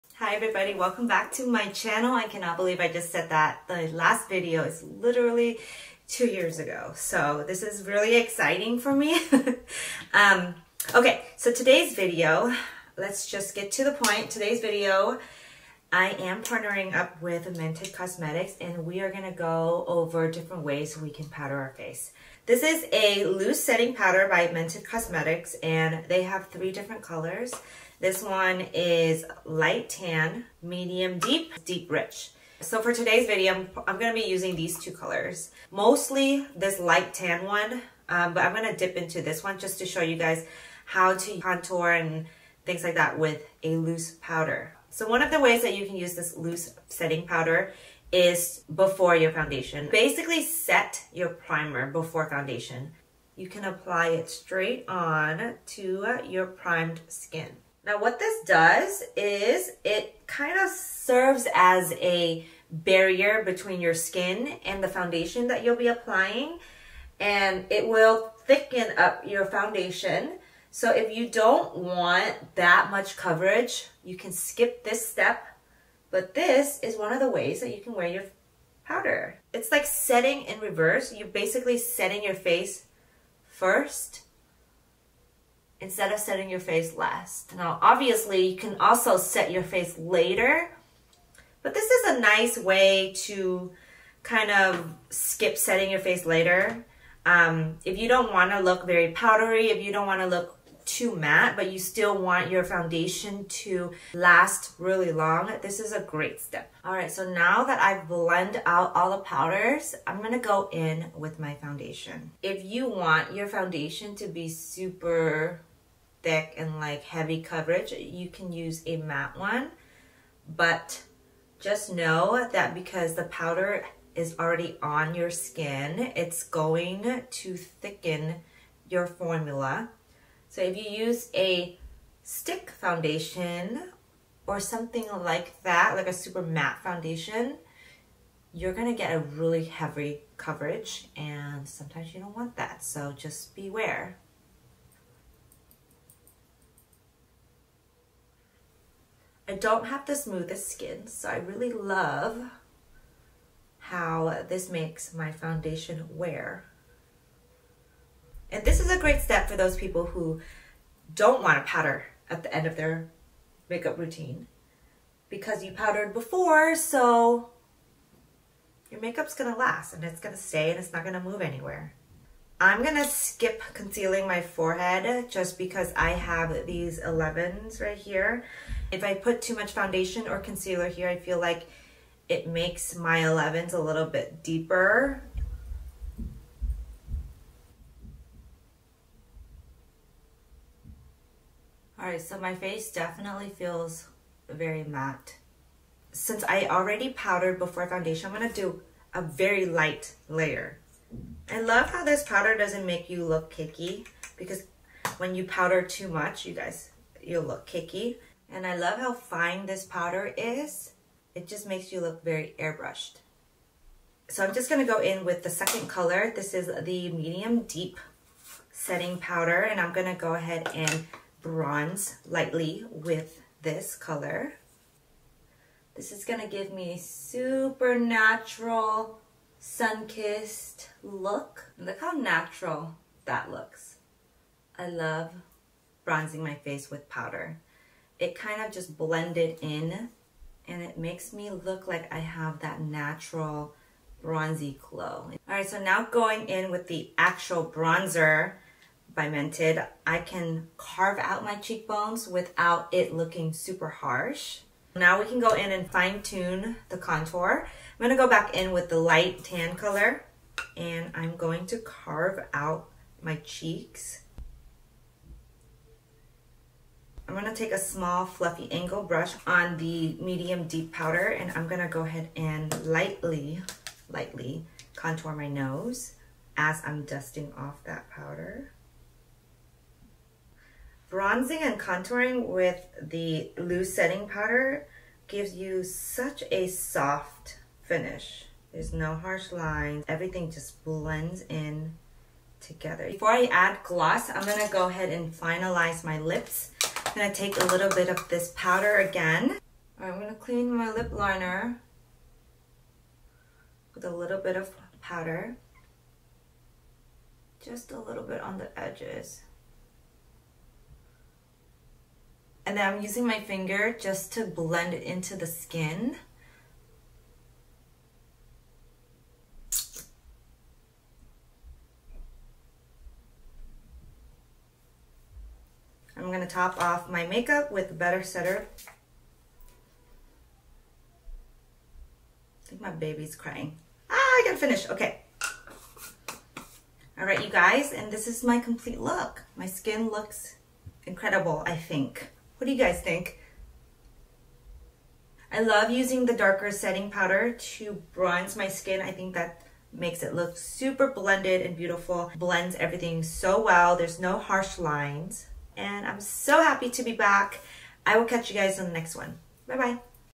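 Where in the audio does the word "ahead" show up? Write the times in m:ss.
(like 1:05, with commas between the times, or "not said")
3:40, 4:32, 4:54.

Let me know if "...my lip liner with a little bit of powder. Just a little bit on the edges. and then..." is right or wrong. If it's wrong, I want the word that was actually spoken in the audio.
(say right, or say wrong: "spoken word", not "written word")
right.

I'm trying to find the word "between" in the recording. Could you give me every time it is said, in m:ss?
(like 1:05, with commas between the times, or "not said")
1:03.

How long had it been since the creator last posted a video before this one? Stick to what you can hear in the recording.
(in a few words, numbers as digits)
2 years.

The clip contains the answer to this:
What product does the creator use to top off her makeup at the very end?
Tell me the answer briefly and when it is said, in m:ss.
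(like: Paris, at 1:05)
Better Setter, at 5:27.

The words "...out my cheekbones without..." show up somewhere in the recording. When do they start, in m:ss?
4:11.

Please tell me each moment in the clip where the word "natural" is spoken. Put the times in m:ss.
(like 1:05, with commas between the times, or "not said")
3:47, 3:52, 4:02.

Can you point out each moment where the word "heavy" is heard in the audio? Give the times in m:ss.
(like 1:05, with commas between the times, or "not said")
1:57, 2:19.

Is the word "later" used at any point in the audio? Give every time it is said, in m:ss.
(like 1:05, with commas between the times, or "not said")
1:29, 1:36.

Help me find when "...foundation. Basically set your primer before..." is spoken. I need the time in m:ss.
0:49.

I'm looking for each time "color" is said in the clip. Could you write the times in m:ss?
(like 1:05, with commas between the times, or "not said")
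0:27, 0:34, 3:35, 3:43, 4:19.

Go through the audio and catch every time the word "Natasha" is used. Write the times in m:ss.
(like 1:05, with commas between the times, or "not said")
not said.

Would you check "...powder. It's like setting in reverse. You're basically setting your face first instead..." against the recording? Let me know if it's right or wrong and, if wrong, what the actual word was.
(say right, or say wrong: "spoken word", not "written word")
right.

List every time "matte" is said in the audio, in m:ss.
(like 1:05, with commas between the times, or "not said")
1:41, 1:58, 2:16, 3:14.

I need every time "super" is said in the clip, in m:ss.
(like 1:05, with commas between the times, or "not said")
1:54, 2:16, 3:46, 4:13, 5:50.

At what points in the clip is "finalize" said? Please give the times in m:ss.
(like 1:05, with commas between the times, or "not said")
4:55.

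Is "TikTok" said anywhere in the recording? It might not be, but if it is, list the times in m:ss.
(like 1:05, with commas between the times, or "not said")
not said.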